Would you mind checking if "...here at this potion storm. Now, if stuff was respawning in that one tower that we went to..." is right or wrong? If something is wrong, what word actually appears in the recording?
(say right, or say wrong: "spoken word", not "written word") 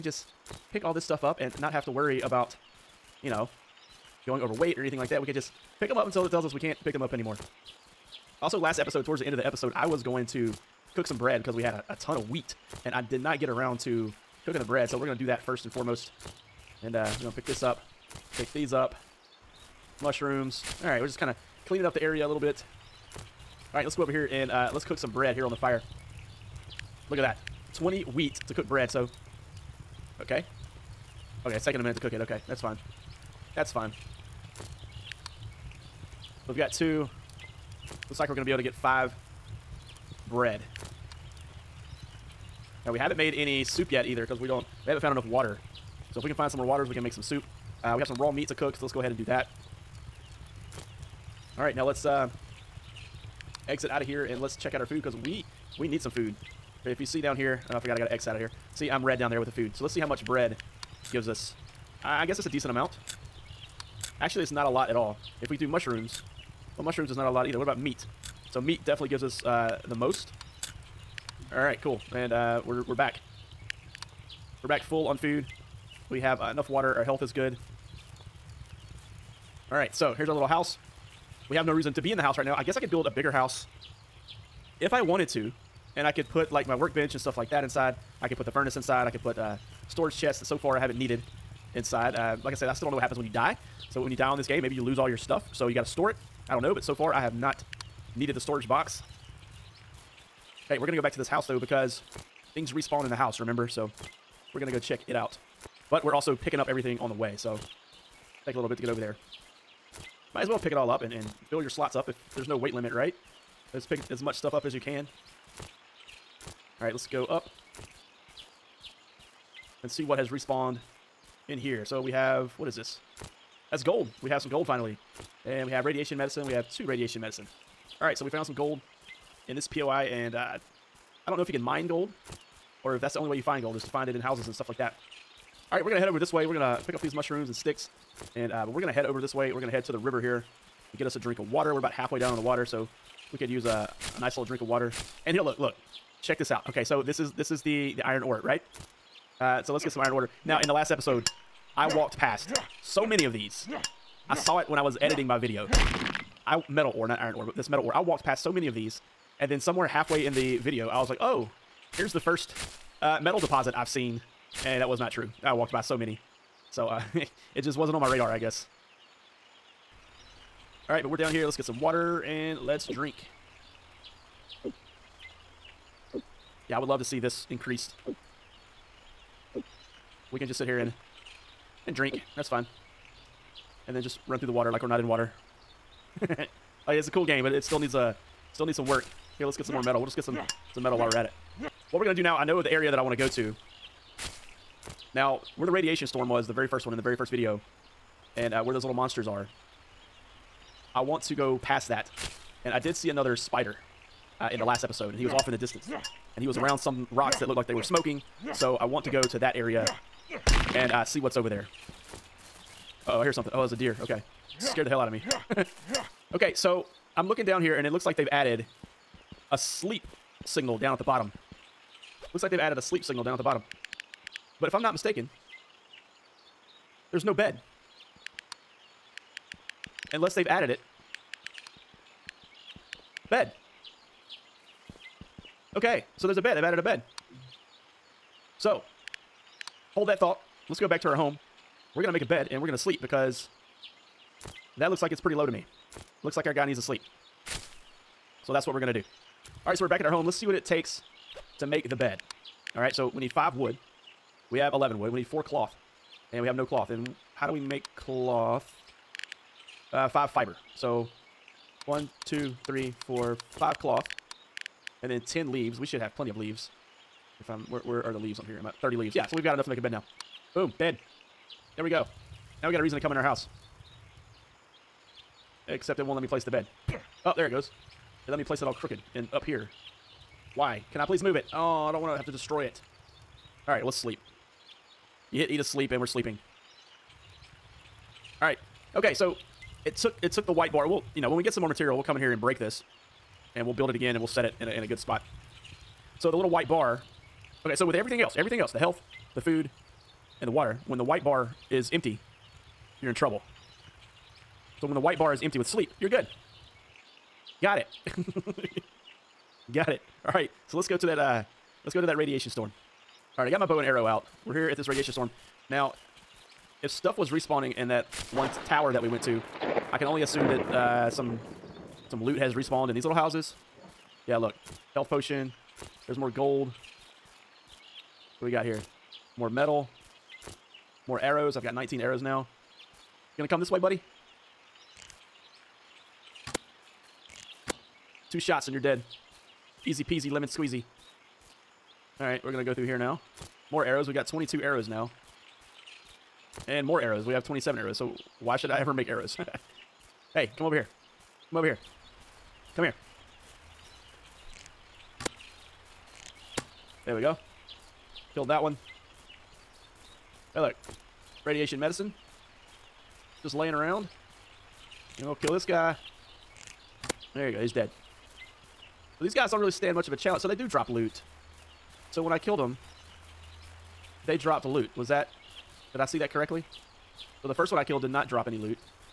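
wrong: "radiation", not "potion".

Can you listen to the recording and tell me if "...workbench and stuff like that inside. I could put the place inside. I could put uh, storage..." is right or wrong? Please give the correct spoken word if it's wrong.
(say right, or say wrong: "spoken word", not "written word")
wrong: "furnace", not "place".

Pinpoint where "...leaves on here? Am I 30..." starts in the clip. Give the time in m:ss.
4:28.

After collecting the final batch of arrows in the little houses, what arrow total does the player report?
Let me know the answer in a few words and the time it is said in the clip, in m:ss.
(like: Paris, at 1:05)
27, at 5:47.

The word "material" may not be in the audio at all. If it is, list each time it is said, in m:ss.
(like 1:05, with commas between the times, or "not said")
4:51.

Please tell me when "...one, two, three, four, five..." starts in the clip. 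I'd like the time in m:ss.
4:21.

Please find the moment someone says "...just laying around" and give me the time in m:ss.
6:03.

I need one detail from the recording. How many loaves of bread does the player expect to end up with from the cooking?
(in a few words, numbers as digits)
5.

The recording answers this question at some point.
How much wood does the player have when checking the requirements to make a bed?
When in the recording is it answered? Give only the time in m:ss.
4:14.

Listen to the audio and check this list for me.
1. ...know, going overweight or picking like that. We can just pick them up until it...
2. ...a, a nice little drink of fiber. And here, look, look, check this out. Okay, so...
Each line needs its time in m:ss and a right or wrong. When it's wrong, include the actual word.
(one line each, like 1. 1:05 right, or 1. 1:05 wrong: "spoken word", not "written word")
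1. 0:03 wrong: "anything", not "picking"
2. 2:23 wrong: "water", not "fiber".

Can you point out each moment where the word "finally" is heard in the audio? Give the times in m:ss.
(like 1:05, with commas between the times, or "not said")
2:04.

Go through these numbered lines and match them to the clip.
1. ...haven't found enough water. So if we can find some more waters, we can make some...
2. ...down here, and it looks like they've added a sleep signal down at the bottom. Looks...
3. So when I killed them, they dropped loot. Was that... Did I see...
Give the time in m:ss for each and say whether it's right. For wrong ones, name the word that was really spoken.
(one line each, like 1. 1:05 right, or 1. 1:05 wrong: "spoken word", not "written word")
1. 0:44 right
2. 3:37 right
3. 6:12 right.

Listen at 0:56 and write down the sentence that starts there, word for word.
If you see down here, oh, I forgot I got an X out of here.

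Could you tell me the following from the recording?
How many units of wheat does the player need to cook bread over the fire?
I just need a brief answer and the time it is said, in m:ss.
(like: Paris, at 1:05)
20, at 0:27.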